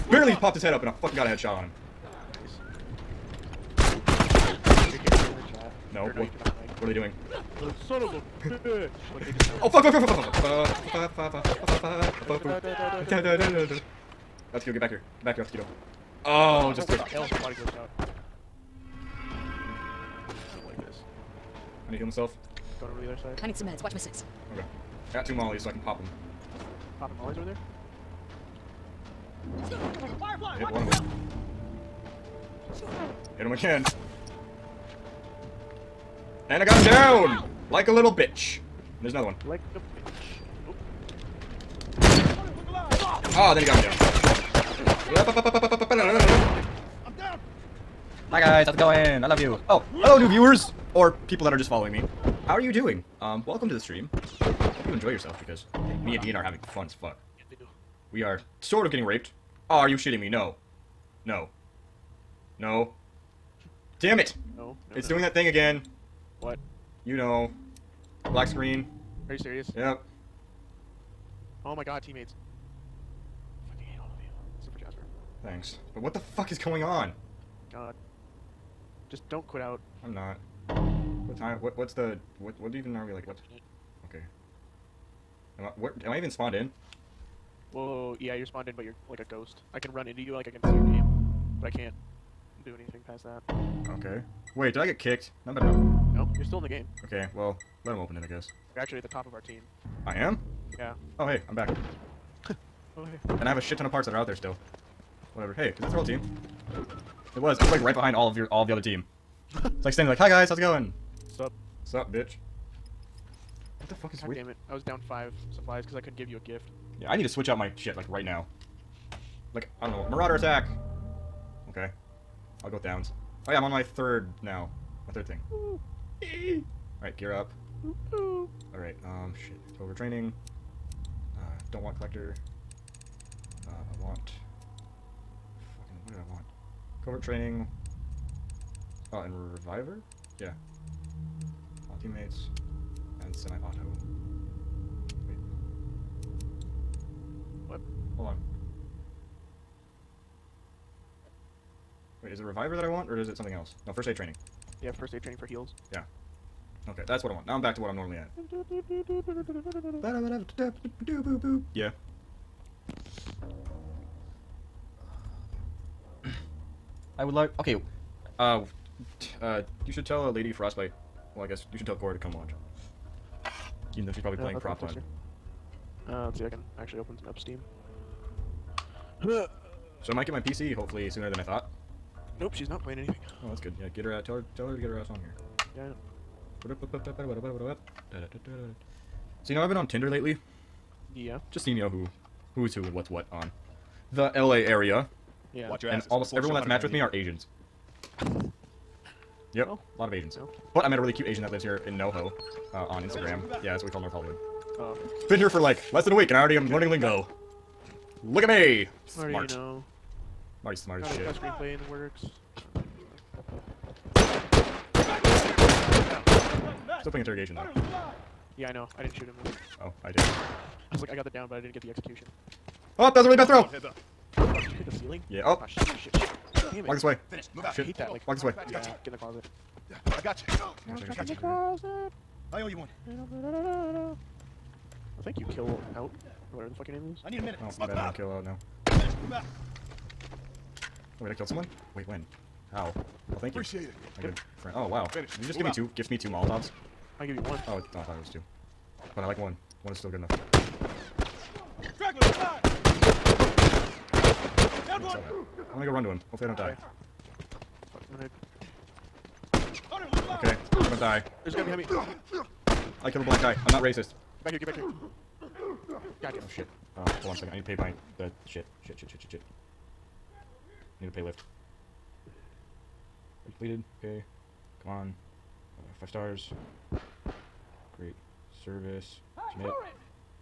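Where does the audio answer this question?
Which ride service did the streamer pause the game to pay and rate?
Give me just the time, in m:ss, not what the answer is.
4:31.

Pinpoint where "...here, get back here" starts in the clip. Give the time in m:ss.
4:24.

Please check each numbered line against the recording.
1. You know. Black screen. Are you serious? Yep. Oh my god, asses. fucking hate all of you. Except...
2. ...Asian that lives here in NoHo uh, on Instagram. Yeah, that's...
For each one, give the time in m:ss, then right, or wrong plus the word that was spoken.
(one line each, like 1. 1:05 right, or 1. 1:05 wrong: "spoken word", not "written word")
1. 1:07 wrong: "teammates", not "asses"
2. 3:21 right.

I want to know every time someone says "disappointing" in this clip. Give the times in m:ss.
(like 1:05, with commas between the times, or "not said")
not said.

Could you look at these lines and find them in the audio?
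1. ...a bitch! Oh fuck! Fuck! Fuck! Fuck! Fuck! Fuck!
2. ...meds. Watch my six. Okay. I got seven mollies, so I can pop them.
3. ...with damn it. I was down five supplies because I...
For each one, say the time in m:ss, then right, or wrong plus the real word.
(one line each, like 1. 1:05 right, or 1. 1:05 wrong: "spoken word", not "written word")
1. 0:08 right
2. 0:23 wrong: "two", not "seven"
3. 1:54 right.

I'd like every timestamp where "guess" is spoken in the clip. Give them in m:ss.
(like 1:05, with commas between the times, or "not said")
1:38, 2:51.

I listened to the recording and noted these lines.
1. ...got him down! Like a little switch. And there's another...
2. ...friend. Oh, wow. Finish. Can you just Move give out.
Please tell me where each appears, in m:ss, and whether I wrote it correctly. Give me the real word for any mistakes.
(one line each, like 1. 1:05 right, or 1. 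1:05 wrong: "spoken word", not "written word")
1. 0:36 wrong: "bitch", not "switch"
2. 4:04 right.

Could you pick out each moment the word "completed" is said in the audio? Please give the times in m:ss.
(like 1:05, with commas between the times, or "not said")
4:33.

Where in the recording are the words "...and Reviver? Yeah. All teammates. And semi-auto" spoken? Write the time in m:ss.
2:19.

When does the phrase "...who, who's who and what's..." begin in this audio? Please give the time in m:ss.
3:11.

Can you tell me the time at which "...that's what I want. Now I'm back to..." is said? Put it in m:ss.
2:37.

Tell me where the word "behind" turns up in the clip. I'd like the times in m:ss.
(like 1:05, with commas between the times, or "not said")
1:47, 4:21.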